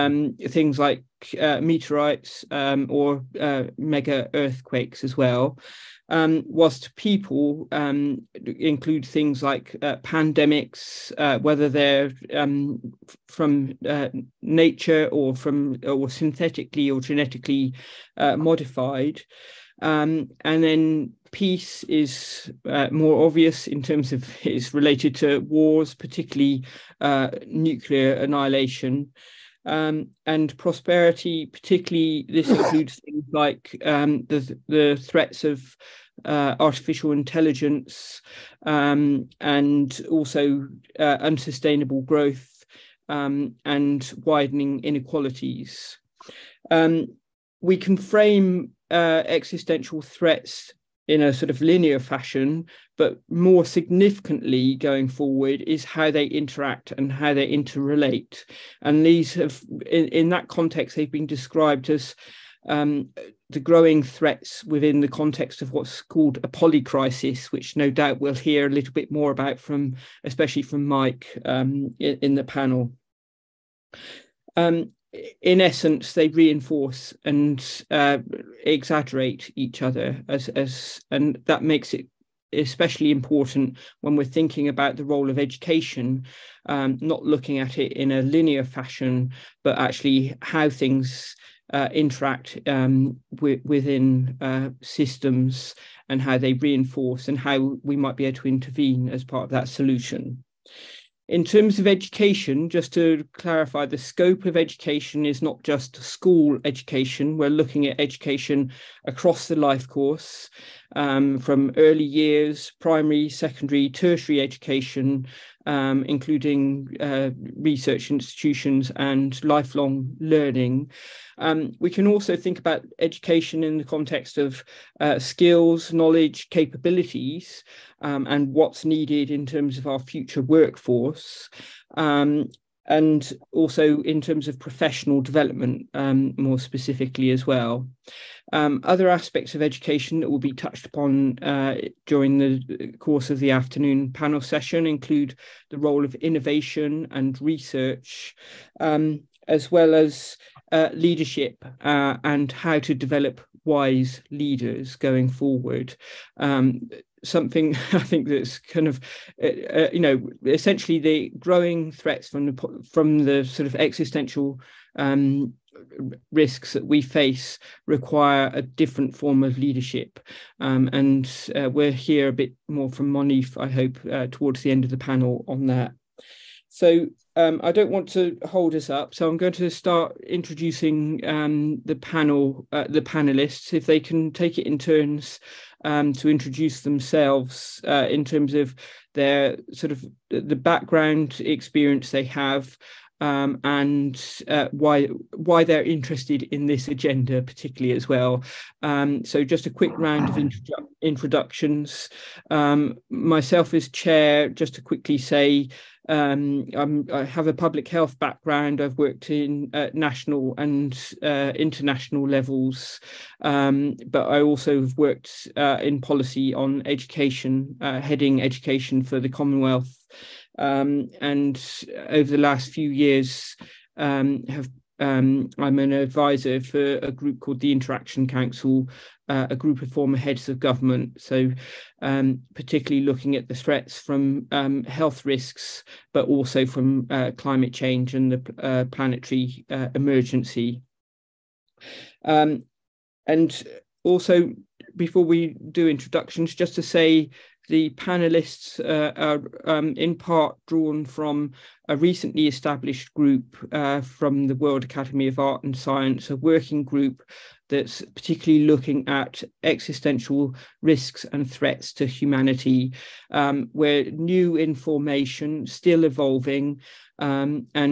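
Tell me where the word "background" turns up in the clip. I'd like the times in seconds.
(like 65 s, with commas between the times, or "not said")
190 s, 208 s.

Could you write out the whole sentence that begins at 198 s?
Um, so just a quick round of introdu- introductions.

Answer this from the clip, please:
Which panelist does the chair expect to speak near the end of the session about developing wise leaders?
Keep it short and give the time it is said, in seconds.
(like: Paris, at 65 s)
Moneef, at 173 s.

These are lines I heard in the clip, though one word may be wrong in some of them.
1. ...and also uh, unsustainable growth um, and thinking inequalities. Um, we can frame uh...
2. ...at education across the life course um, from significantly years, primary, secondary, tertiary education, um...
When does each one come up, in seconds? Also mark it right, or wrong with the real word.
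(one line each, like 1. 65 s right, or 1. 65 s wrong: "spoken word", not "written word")
1. 39 s wrong: "widening", not "thinking"
2. 107 s wrong: "early", not "significantly".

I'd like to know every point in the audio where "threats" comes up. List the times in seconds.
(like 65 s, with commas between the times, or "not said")
35 s, 50 s, 64 s, 161 s, 233 s, 261 s.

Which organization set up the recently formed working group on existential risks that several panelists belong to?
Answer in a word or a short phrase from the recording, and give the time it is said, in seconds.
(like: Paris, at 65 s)
World Academy of Art and Science, at 254 s.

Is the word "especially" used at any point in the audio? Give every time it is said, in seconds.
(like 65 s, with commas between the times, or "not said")
70 s, 82 s.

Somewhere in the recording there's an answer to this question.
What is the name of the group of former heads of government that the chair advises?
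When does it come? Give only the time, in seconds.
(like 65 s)
227 s.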